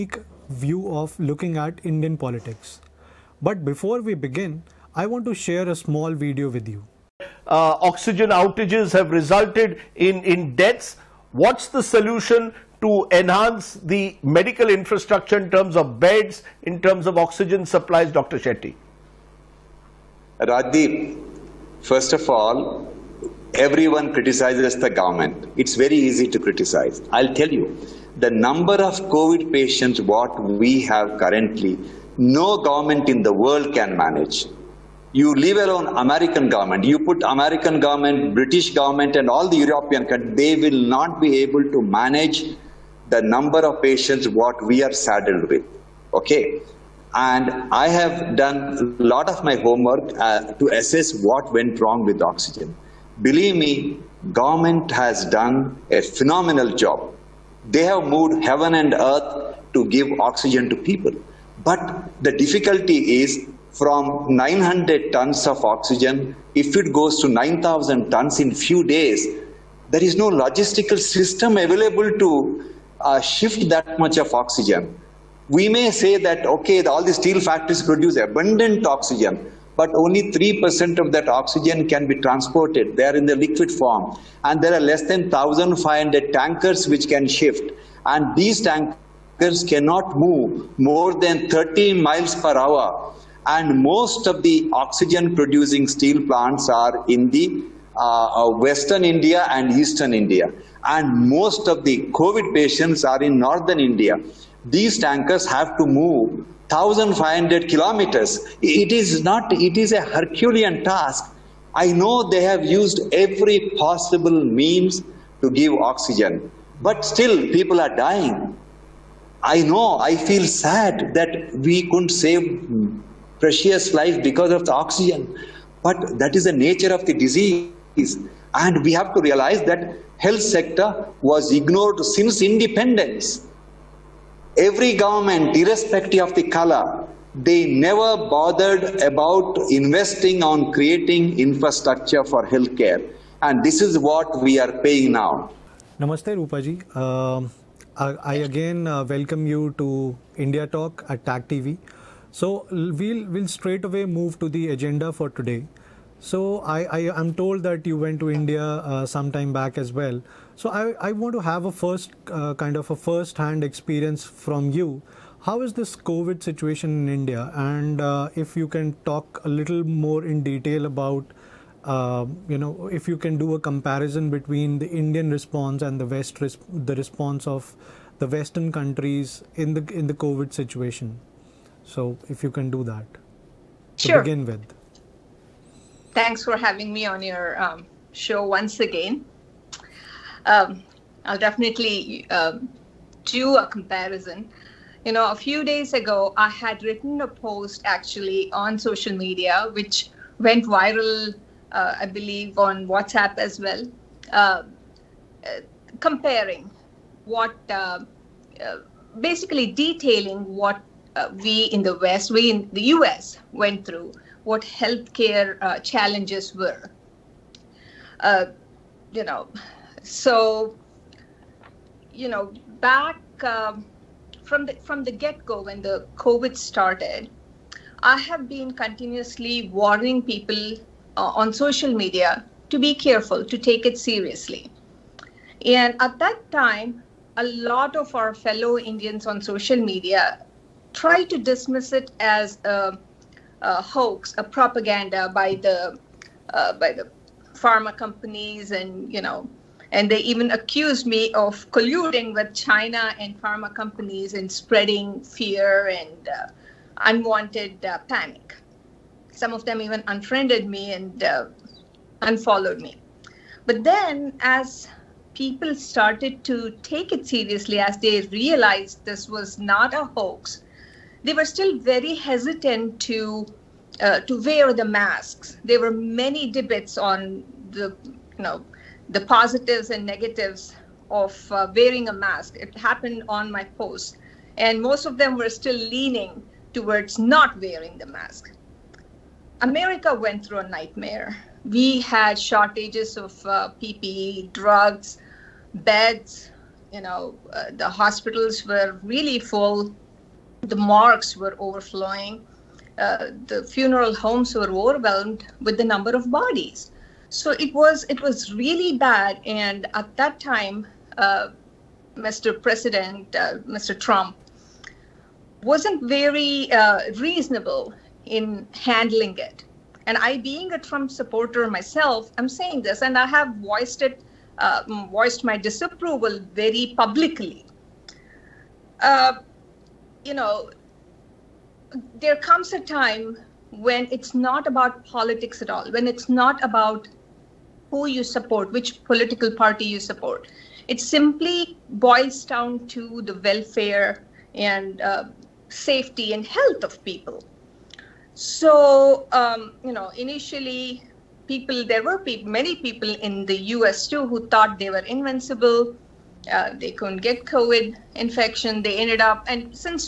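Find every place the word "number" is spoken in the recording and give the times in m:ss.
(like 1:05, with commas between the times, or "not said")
0:28, 0:43, 5:05.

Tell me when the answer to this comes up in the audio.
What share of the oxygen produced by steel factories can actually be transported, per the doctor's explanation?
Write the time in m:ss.
1:20.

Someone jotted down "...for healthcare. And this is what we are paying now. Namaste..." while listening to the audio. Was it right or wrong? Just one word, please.
right.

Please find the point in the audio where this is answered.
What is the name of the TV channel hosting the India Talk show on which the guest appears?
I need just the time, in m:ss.
2:31.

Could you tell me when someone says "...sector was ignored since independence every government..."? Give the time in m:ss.
2:10.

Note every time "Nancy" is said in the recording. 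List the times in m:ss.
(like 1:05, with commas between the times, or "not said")
not said.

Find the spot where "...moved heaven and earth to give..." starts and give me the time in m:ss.
0:58.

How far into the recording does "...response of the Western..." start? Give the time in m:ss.
2:56.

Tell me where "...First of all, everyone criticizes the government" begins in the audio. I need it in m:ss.
0:21.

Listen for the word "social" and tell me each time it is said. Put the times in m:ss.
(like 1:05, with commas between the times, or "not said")
3:18, 3:51, 3:59.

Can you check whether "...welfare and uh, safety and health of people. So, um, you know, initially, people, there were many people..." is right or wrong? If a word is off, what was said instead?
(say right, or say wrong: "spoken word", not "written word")
right.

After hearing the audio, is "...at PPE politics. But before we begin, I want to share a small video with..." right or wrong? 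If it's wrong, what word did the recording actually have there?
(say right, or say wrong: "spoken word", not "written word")
wrong: "Indian", not "PPE".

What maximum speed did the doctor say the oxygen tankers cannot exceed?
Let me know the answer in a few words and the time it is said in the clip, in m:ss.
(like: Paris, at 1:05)
30 miles per hour, at 1:31.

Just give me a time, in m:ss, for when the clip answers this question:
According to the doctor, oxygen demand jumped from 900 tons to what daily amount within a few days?
1:07.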